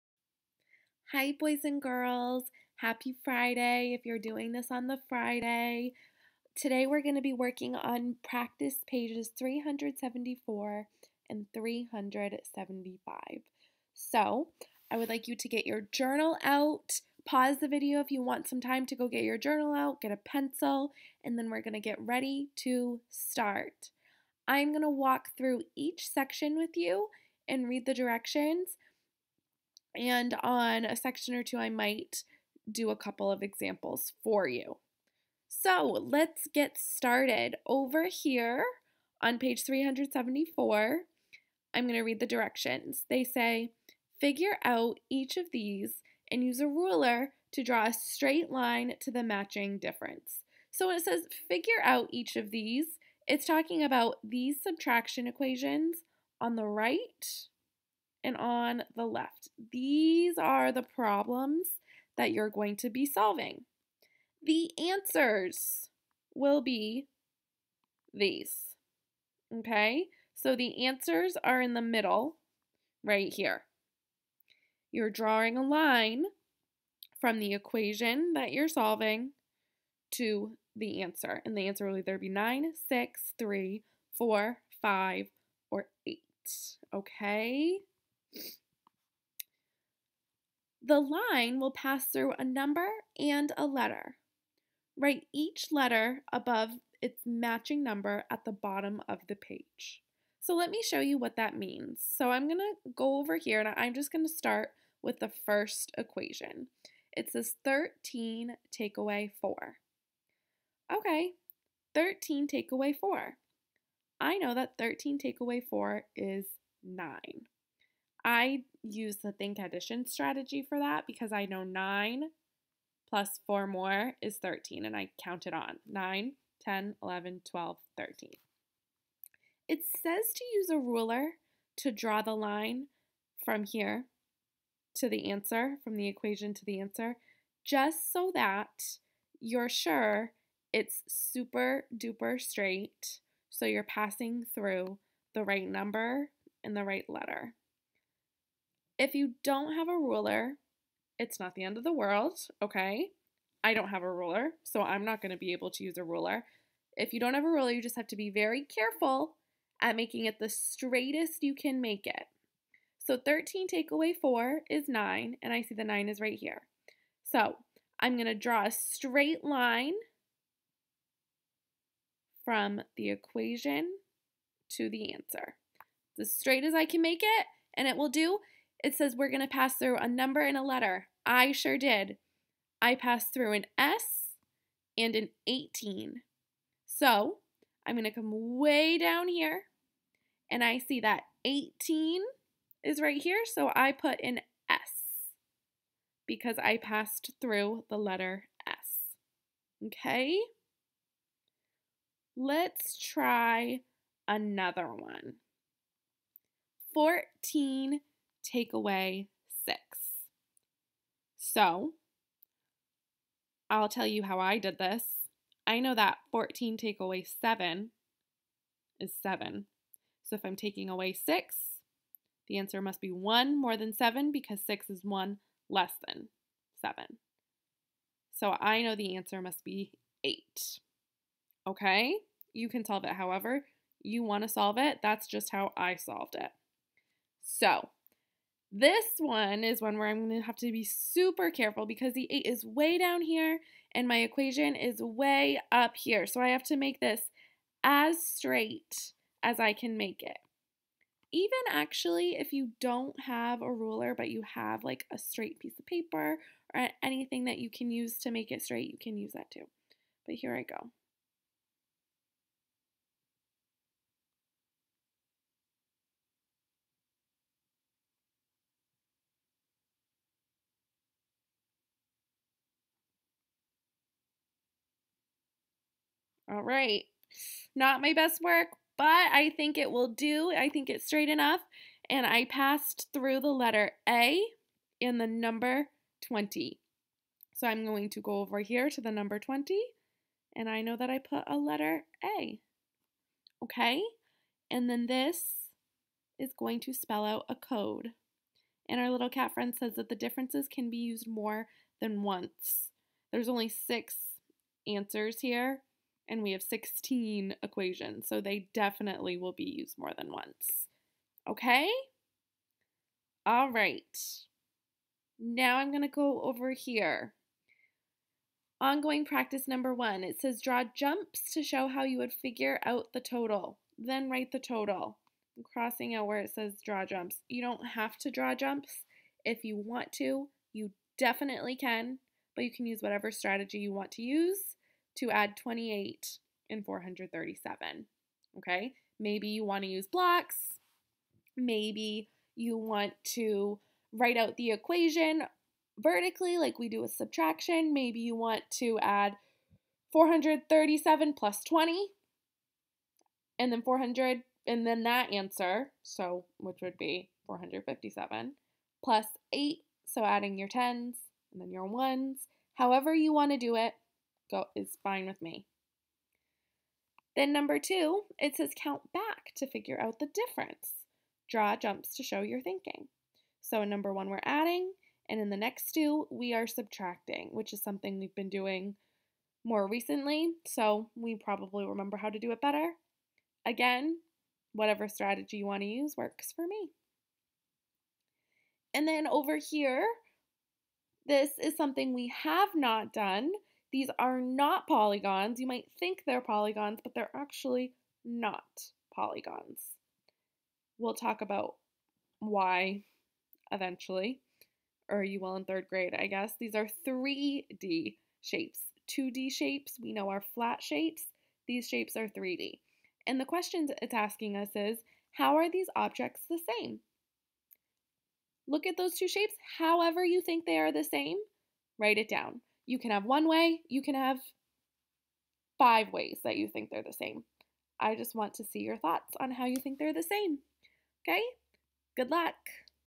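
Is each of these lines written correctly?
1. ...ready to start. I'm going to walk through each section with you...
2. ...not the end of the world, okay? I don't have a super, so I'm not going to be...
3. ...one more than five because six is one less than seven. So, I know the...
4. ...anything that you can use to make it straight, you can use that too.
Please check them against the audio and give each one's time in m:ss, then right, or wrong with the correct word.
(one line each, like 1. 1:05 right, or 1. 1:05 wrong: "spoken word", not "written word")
1. 0:21 right
2. 2:31 wrong: "ruler", not "super"
3. 3:43 wrong: "seven", not "five"
4. 4:17 right.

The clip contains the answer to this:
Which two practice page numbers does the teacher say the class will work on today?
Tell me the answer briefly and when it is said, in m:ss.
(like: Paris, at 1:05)
374 and 375, at 0:09.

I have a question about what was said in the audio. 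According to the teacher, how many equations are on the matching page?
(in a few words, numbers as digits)
16.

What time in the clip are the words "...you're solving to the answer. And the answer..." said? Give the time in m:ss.
1:18.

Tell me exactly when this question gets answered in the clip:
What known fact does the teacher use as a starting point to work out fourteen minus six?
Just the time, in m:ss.
3:36.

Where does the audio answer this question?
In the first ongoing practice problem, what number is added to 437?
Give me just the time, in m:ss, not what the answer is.
5:35.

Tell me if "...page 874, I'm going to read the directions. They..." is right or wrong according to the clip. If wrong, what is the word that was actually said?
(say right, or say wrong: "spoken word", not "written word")
wrong: "374", not "874".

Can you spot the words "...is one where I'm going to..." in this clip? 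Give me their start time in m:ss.
3:59.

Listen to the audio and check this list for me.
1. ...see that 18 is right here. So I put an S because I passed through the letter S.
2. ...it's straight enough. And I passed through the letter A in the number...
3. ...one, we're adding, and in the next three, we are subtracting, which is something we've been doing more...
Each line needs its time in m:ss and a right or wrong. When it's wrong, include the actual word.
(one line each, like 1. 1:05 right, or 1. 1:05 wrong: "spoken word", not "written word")
1. 3:10 right
2. 4:40 right
3. 6:14 wrong: "two", not "three".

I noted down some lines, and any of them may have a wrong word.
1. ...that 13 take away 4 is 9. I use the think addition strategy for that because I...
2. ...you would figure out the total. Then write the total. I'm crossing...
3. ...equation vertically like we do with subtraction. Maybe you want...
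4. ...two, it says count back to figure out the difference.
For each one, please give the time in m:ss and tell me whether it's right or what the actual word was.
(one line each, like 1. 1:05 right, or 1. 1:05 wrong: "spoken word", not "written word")
1. 1:54 right
2. 5:22 right
3. 5:44 right
4. 6:07 right.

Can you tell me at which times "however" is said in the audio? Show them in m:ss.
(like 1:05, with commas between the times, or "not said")
3:53, 6:02, 6:59.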